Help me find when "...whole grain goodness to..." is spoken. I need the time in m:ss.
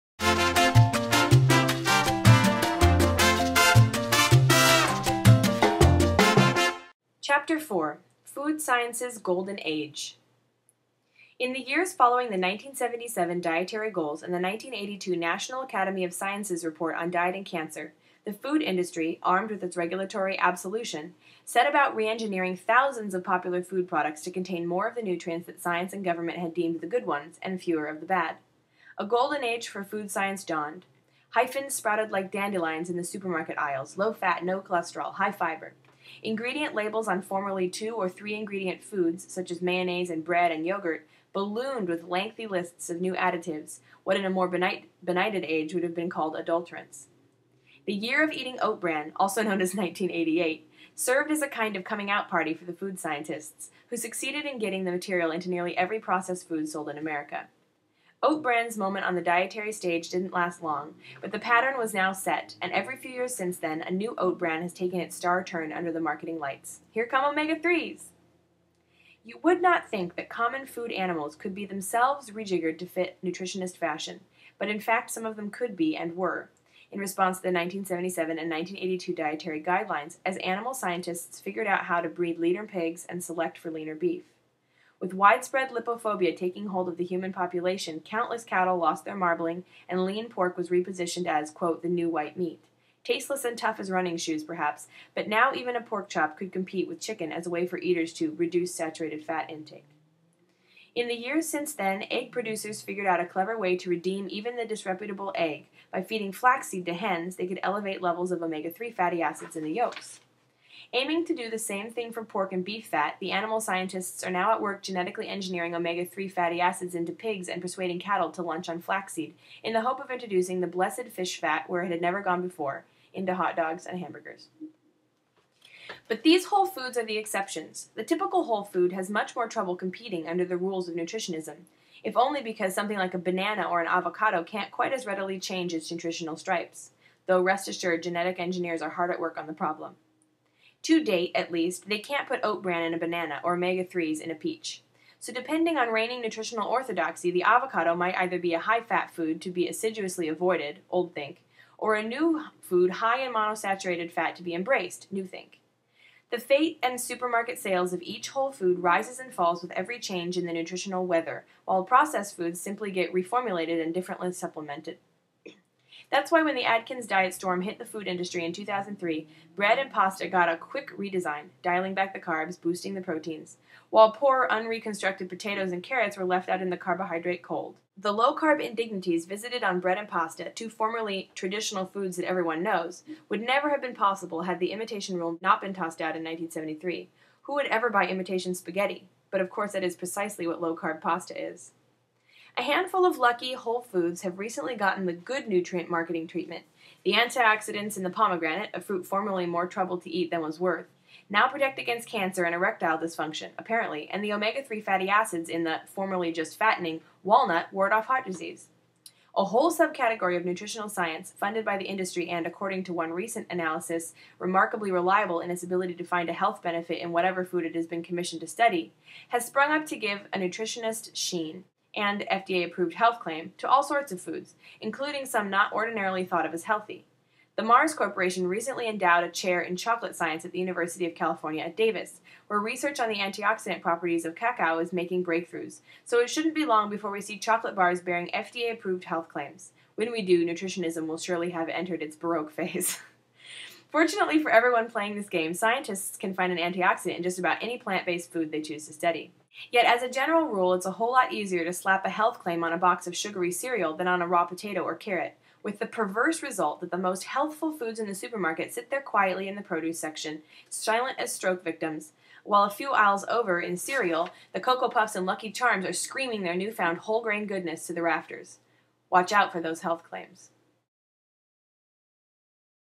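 4:26.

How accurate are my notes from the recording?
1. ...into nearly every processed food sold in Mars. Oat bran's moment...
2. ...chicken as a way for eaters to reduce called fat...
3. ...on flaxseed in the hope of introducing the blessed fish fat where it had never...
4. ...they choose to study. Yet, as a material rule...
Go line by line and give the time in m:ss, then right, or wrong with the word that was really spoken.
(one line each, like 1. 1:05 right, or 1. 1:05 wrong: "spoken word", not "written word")
1. 0:55 wrong: "America", not "Mars"
2. 1:37 wrong: "saturated", not "called"
3. 1:58 right
4. 4:08 wrong: "general", not "material".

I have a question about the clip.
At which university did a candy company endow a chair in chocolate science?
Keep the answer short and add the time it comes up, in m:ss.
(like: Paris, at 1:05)
University of California at Davis, at 3:50.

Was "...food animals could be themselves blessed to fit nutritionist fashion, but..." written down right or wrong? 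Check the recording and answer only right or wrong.
wrong.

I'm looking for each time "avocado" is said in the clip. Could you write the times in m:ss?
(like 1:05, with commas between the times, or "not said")
2:13, 2:27.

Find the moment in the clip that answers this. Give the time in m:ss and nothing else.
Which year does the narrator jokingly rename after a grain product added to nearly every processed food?
0:49.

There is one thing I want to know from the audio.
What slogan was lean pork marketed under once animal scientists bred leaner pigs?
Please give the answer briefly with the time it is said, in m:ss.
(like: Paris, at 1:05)
the new white meat, at 1:31.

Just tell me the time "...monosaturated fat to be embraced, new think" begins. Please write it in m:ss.
2:33.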